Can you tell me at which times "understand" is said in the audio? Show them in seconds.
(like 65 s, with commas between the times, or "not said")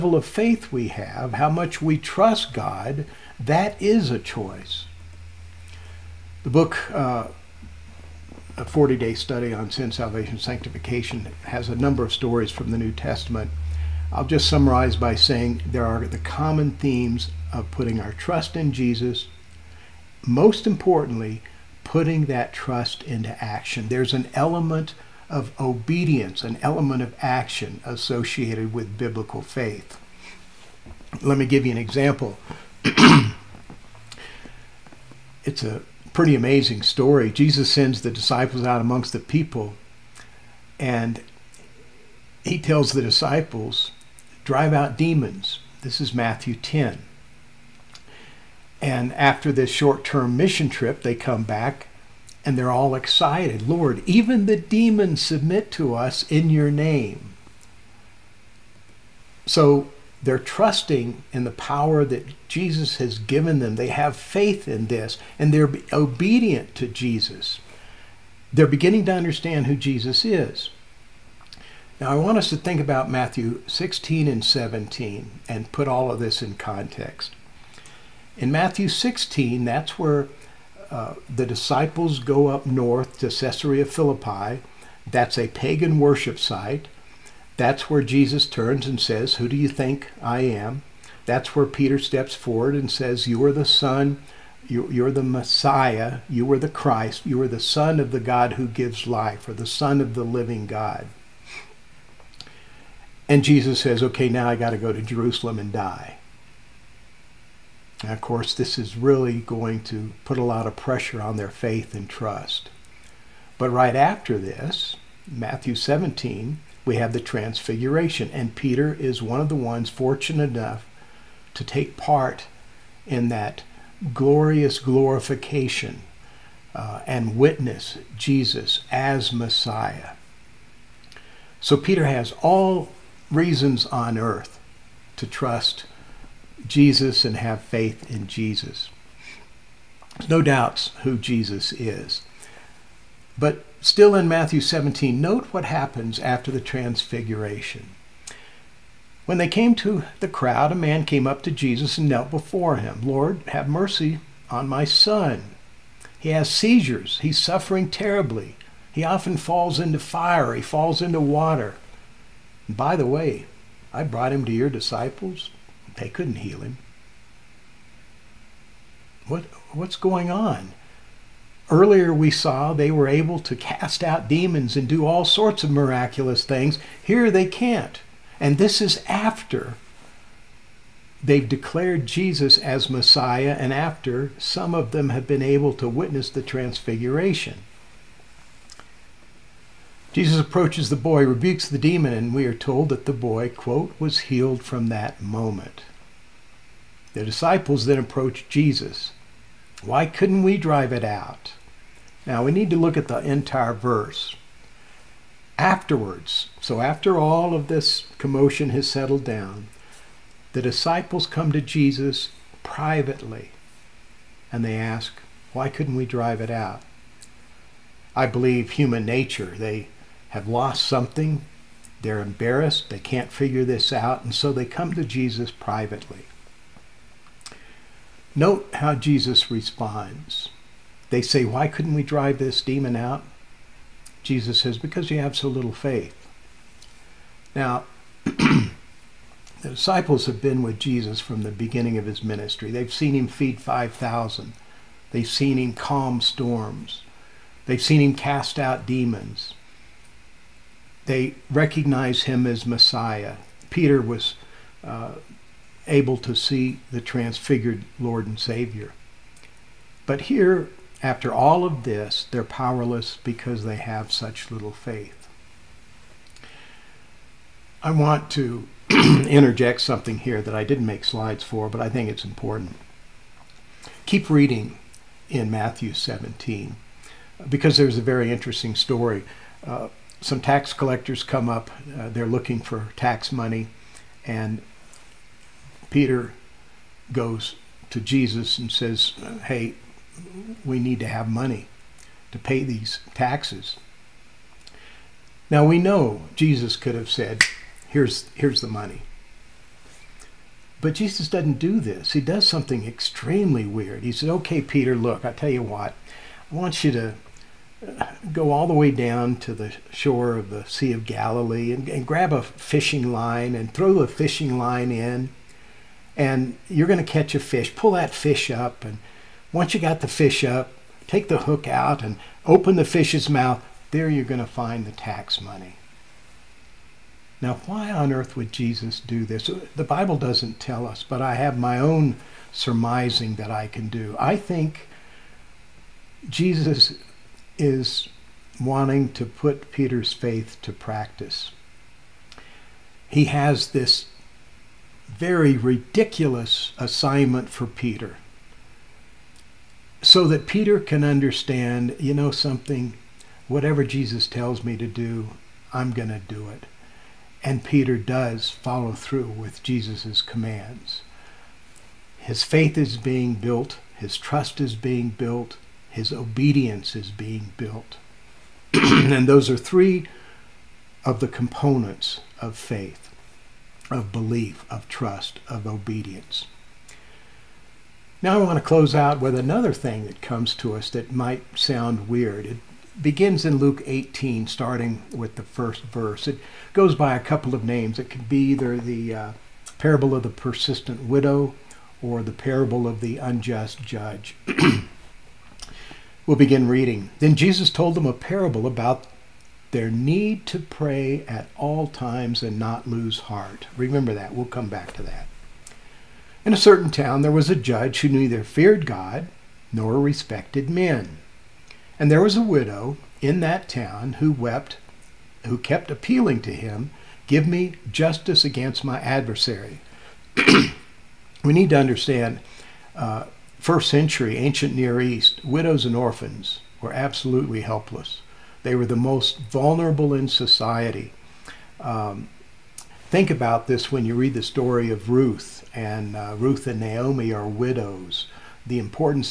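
69 s, 351 s, 421 s.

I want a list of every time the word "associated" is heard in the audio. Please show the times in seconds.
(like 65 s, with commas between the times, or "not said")
27 s.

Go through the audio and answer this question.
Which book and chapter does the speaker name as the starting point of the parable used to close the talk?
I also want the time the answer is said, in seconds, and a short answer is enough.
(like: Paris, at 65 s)
Luke 18, at 383 s.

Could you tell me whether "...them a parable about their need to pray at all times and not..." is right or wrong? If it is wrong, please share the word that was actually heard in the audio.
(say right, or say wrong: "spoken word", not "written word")
right.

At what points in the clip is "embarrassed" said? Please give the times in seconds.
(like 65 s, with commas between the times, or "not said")
222 s.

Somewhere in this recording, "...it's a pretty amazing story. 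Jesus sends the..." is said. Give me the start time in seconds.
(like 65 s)
35 s.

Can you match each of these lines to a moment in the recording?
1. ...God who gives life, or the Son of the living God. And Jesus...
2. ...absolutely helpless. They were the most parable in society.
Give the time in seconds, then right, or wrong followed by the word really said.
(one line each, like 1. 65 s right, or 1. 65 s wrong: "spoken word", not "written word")
1. 98 s right
2. 426 s wrong: "vulnerable", not "parable".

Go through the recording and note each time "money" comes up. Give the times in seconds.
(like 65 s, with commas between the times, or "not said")
283 s, 291 s, 298 s, 325 s.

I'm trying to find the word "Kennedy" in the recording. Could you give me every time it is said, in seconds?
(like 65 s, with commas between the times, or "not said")
not said.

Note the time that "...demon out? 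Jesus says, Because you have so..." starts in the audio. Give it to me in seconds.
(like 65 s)
232 s.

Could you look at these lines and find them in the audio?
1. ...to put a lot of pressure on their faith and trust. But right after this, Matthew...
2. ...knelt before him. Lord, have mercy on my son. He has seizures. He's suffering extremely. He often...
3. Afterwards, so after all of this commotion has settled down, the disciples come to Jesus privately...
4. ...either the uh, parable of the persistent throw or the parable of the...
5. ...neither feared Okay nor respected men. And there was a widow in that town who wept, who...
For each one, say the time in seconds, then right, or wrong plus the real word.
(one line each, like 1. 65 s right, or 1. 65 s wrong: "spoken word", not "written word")
1. 109 s right
2. 152 s wrong: "terribly", not "extremely"
3. 205 s right
4. 388 s wrong: "widow", not "throw"
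5. 408 s wrong: "God", not "Okay".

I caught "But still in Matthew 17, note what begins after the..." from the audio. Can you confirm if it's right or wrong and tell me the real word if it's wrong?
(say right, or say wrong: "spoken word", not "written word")
wrong: "happens", not "begins".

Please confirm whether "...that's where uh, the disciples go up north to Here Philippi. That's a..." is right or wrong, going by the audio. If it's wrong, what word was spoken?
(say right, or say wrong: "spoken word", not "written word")
wrong: "Caesarea", not "Here".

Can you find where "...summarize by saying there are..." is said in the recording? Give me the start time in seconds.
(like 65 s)
14 s.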